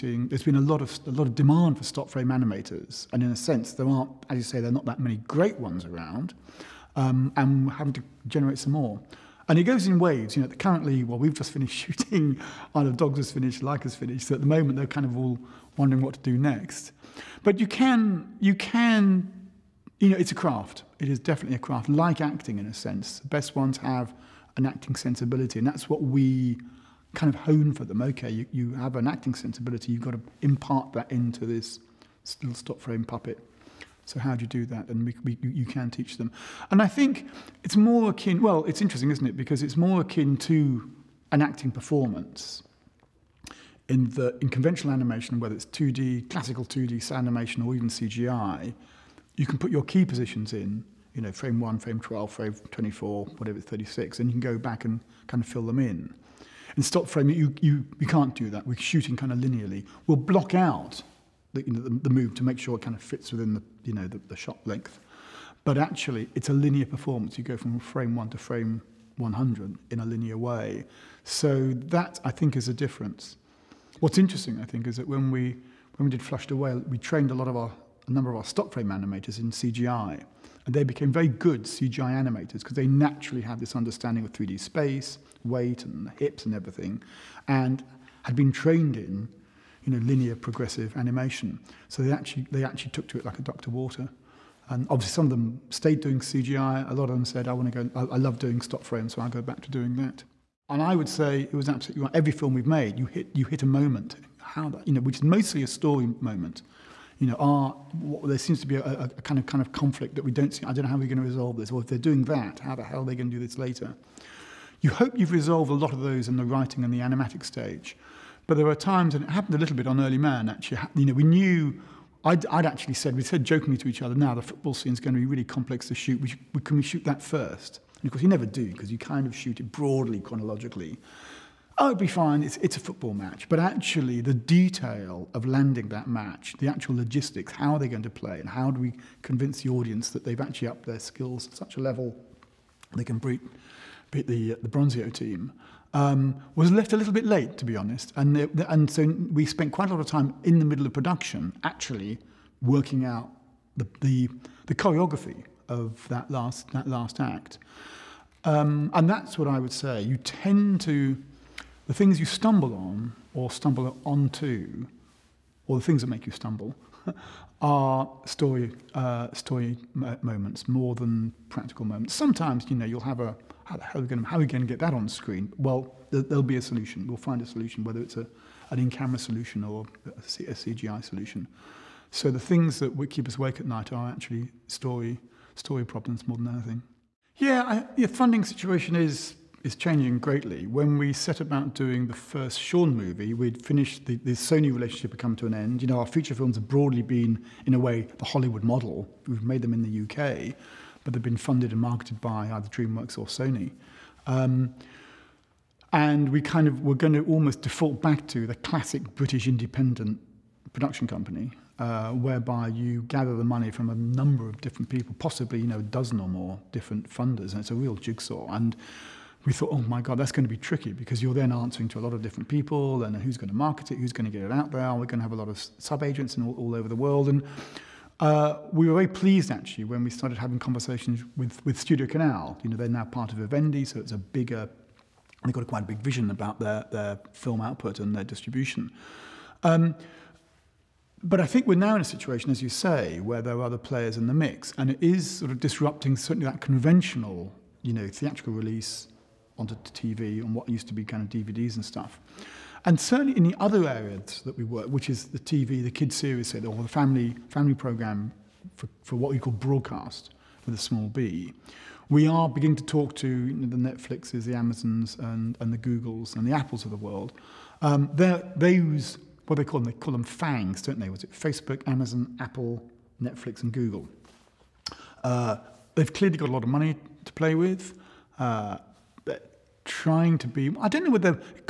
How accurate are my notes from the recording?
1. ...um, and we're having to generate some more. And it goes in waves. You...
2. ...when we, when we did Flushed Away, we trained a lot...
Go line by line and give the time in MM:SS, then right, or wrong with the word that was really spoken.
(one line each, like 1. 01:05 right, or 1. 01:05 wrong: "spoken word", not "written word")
1. 00:06 right
2. 01:15 right.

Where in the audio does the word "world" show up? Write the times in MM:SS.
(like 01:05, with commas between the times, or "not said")
03:46, 04:26.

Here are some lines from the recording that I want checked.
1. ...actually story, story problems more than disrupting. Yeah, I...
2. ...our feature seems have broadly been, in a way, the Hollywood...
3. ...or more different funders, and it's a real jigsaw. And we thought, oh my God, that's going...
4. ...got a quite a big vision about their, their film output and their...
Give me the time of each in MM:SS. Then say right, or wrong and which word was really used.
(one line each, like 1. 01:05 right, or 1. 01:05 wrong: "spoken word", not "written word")
1. 03:04 wrong: "anything", not "disrupting"
2. 03:15 wrong: "films", not "seems"
3. 03:36 right
4. 03:55 right.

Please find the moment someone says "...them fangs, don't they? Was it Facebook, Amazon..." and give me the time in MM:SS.
04:30.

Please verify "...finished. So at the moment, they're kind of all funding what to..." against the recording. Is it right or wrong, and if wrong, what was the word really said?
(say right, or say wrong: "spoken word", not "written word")
wrong: "wondering", not "funding".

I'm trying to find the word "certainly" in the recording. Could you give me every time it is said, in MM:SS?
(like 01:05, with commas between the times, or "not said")
04:06, 04:12.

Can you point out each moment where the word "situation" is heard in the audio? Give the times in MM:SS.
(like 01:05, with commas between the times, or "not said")
03:08, 04:02.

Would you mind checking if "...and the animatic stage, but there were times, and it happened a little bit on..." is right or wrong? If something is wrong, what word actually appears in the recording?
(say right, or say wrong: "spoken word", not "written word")
right.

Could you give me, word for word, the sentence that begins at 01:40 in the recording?
And I would say it was absolutely right.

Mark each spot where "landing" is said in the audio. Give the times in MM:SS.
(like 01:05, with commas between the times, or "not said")
02:15.